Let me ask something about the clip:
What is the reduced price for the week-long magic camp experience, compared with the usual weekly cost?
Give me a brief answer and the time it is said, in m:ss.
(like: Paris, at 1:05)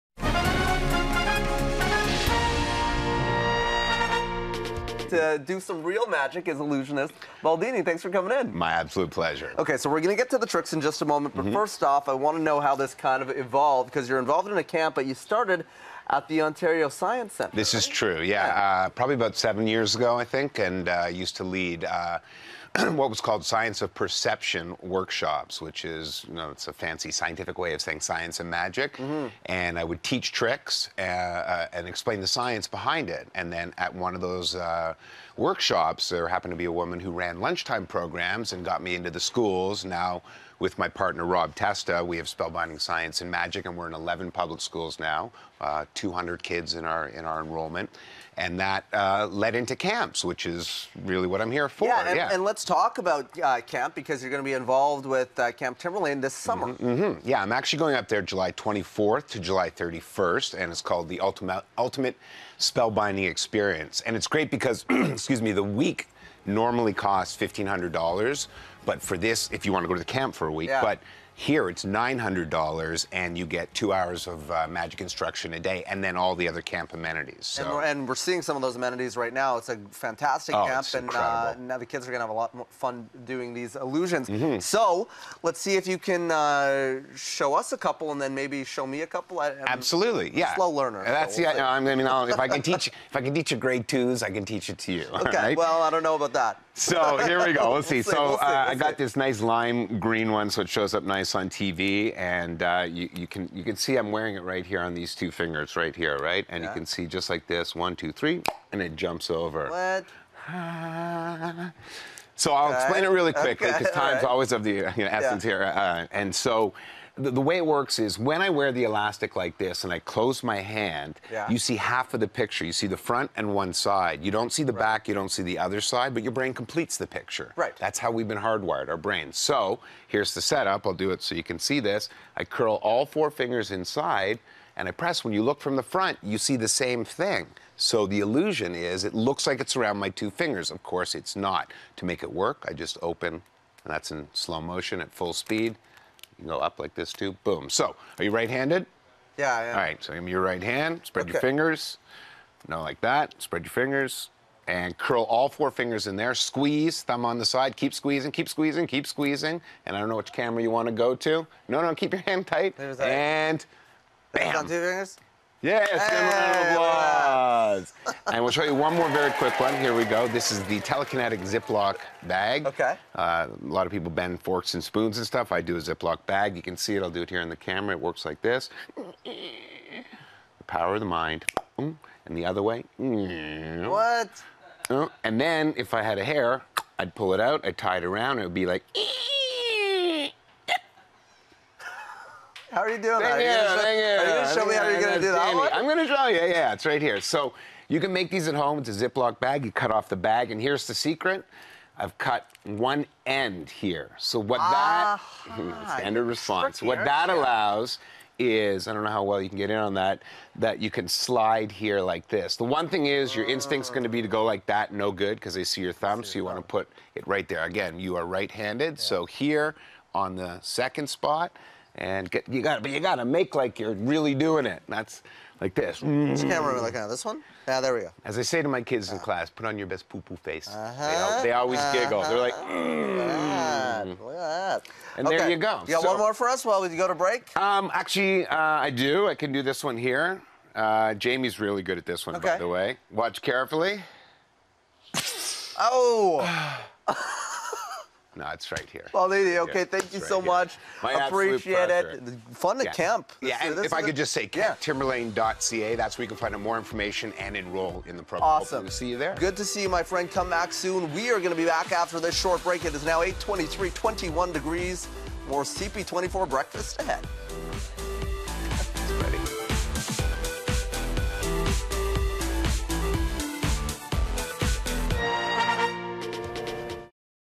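$900, at 1:11.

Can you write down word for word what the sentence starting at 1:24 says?
So let's see if you can uh, show us a couple and then maybe show me a couple.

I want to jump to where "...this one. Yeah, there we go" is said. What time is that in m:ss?
3:47.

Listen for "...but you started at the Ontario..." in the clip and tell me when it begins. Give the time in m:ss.
0:14.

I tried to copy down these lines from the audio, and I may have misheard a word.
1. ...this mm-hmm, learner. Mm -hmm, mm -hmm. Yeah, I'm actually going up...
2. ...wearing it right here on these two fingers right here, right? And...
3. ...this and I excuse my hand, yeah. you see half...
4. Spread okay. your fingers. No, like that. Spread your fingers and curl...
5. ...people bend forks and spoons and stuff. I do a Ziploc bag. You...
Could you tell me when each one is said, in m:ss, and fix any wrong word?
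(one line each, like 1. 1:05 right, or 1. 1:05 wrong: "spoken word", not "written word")
1. 0:56 wrong: "summer", not "learner"
2. 1:44 right
3. 1:59 wrong: "close", not "excuse"
4. 2:31 right
5. 2:53 right.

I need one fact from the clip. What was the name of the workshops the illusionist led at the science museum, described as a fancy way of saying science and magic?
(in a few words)
Science of Perception.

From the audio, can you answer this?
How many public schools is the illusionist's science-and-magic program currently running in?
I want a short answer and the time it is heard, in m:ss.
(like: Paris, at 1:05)
11, at 0:43.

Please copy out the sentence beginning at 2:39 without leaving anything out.
And I don't know which camera you want to go to.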